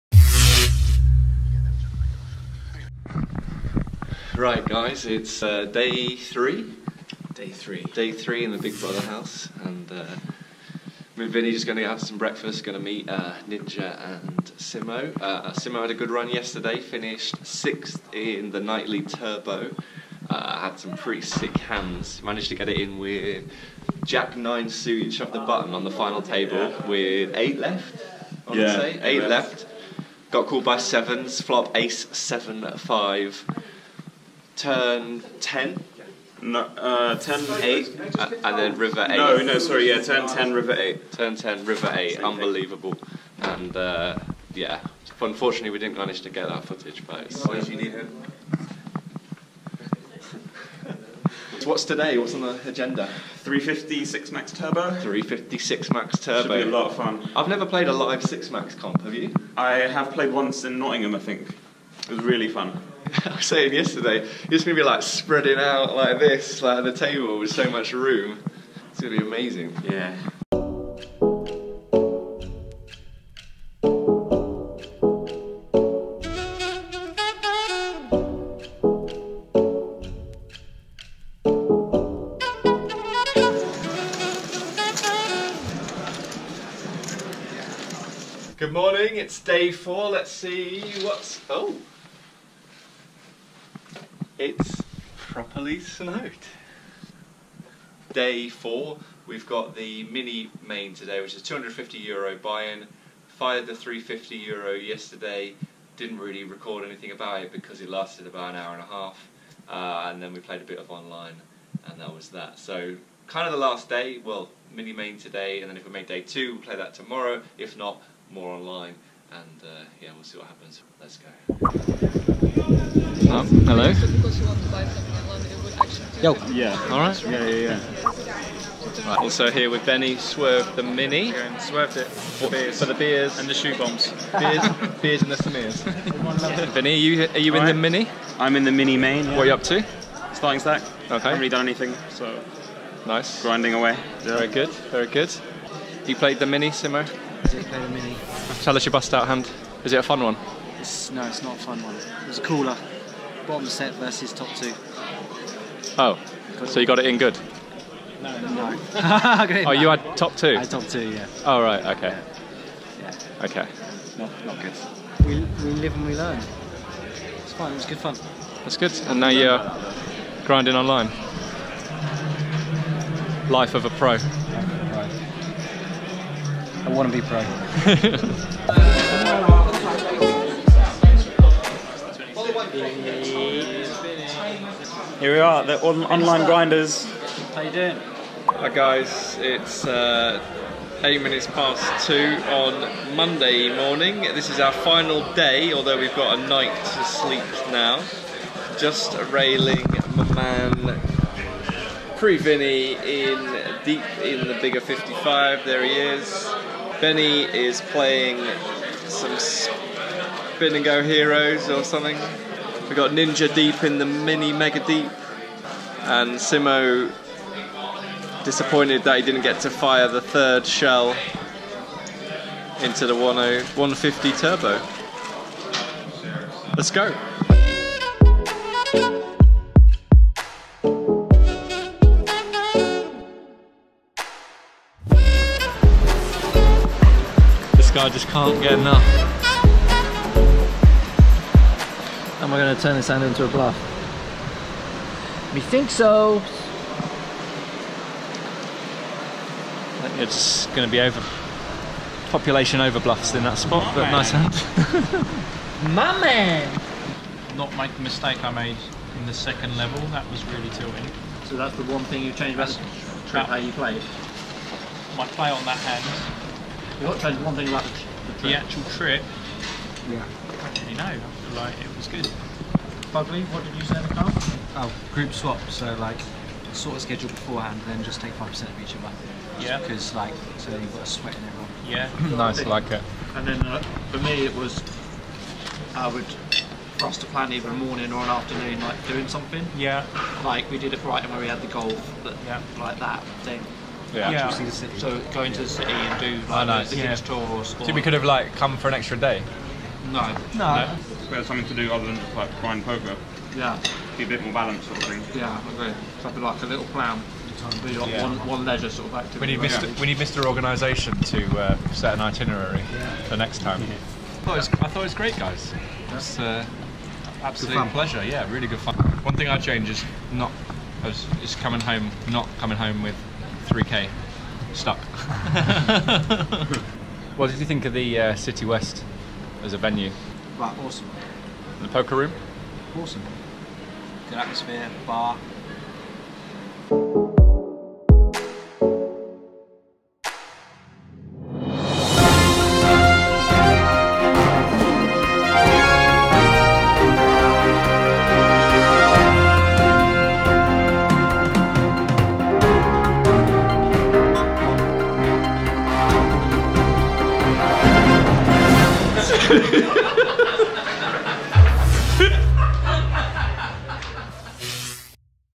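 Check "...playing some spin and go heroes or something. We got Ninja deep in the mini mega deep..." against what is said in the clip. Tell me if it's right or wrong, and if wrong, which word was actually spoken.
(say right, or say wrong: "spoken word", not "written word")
right.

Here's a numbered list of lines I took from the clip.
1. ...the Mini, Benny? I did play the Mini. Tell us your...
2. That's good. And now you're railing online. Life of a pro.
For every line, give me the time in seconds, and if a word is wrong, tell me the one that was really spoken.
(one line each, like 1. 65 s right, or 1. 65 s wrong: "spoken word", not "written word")
1. 146 s wrong: "Simo", not "Benny"
2. 168 s wrong: "grinding", not "railing".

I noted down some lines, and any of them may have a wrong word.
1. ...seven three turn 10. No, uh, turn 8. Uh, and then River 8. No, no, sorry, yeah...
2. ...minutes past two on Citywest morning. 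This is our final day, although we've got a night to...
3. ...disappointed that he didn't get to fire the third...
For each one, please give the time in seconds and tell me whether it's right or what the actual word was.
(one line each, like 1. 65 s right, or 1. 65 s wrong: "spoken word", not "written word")
1. 32 s wrong: "five", not "three"
2. 191 s wrong: "Monday", not "Citywest"
3. 218 s right.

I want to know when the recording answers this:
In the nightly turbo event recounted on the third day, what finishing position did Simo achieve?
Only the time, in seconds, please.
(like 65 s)
17 s.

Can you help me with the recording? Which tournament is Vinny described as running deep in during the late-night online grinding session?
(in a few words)
bigger 55.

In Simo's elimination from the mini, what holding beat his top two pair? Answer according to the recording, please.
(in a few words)
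bottom set.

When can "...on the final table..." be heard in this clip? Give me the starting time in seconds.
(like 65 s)
25 s.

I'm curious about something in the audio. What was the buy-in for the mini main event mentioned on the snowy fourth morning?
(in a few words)
250 euro.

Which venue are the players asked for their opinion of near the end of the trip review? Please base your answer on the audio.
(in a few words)
Citywest.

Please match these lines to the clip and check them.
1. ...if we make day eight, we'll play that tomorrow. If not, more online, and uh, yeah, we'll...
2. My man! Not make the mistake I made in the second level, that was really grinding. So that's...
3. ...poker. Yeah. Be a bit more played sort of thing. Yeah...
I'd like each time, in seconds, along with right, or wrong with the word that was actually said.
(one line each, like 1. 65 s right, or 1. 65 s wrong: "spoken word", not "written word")
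1. 115 s wrong: "two", not "eight"
2. 255 s wrong: "tilting", not "grinding"
3. 302 s wrong: "balanced", not "played".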